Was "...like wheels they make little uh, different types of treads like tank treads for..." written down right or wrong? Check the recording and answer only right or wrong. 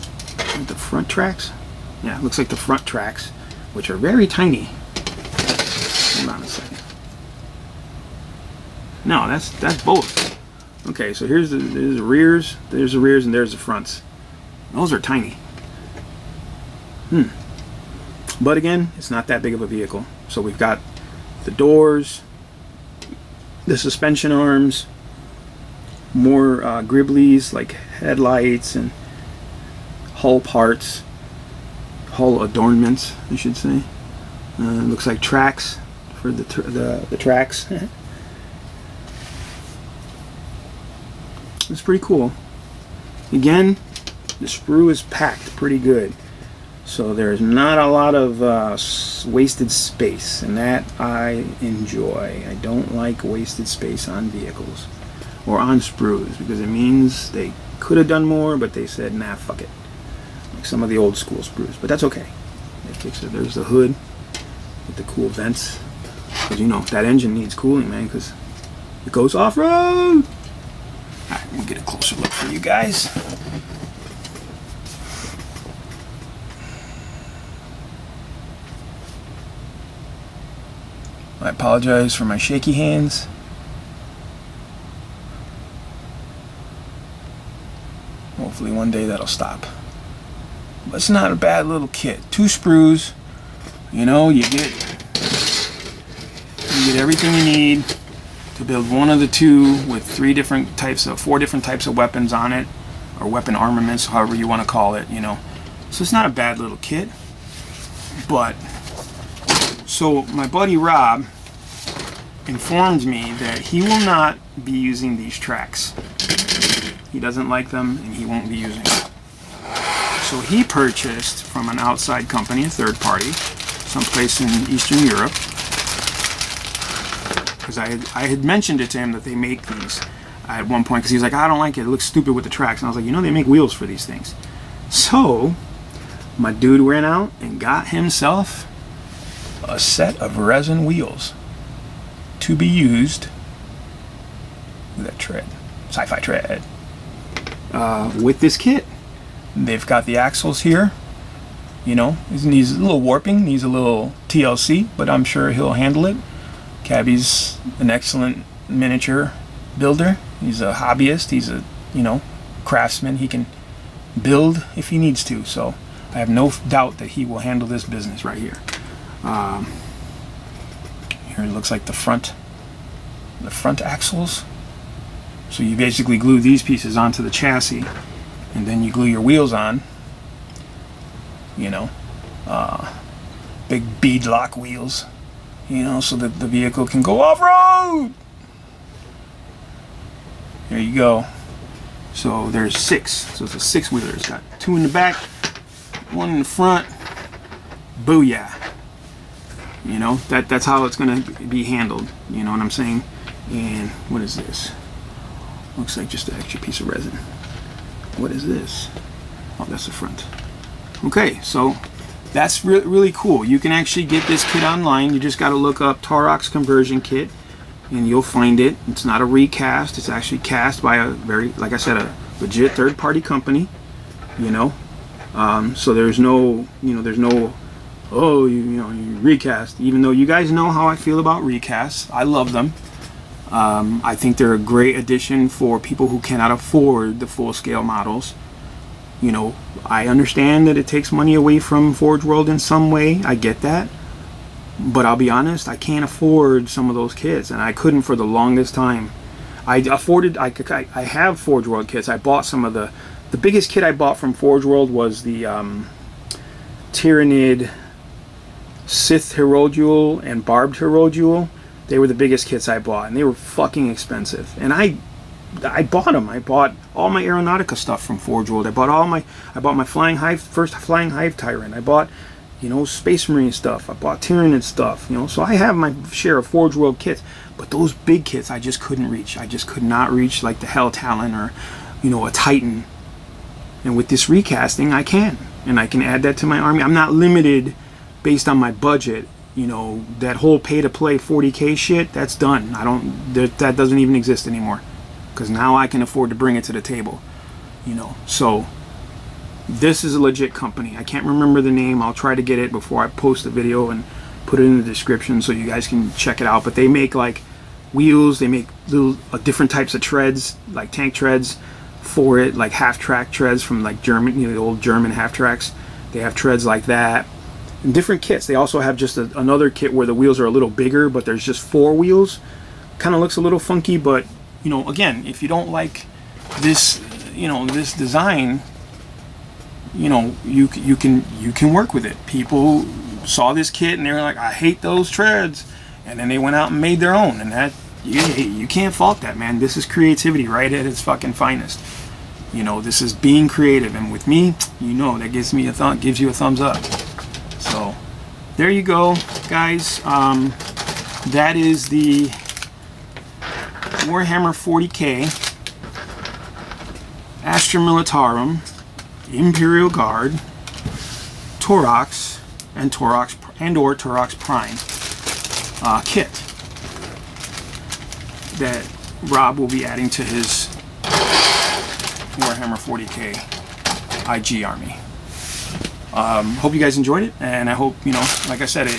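right.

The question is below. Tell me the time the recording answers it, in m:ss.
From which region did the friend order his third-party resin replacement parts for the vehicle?
2:04.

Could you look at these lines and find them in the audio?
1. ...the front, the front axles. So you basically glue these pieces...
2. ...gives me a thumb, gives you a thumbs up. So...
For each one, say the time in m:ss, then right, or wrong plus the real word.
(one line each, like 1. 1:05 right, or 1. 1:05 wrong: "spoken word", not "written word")
1. 2:51 right
2. 5:45 right.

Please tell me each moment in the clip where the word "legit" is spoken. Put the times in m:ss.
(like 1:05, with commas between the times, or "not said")
3:42, 5:00.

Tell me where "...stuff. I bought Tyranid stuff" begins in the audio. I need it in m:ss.
4:33.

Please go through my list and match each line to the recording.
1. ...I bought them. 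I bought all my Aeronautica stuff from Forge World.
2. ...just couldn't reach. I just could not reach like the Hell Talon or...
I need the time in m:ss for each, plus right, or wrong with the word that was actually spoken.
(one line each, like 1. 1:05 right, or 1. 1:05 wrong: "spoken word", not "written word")
1. 4:25 right
2. 4:38 right.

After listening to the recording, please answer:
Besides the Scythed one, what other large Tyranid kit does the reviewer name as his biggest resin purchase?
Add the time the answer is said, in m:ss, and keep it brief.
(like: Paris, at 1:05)
Barbed Hierodule, at 4:20.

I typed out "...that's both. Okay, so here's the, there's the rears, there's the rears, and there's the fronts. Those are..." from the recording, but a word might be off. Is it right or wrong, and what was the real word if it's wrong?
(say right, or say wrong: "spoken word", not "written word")
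right.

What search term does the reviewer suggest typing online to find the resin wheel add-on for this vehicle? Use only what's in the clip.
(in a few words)
Taurox Conversion Kit.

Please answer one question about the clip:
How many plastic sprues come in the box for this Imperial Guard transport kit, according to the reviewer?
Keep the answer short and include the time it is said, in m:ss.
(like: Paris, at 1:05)
2, at 1:32.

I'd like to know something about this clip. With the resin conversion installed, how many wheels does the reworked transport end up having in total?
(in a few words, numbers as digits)
6.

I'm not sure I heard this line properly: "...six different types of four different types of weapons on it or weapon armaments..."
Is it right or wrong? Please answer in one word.
wrong.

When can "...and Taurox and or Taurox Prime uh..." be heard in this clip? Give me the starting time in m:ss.
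6:02.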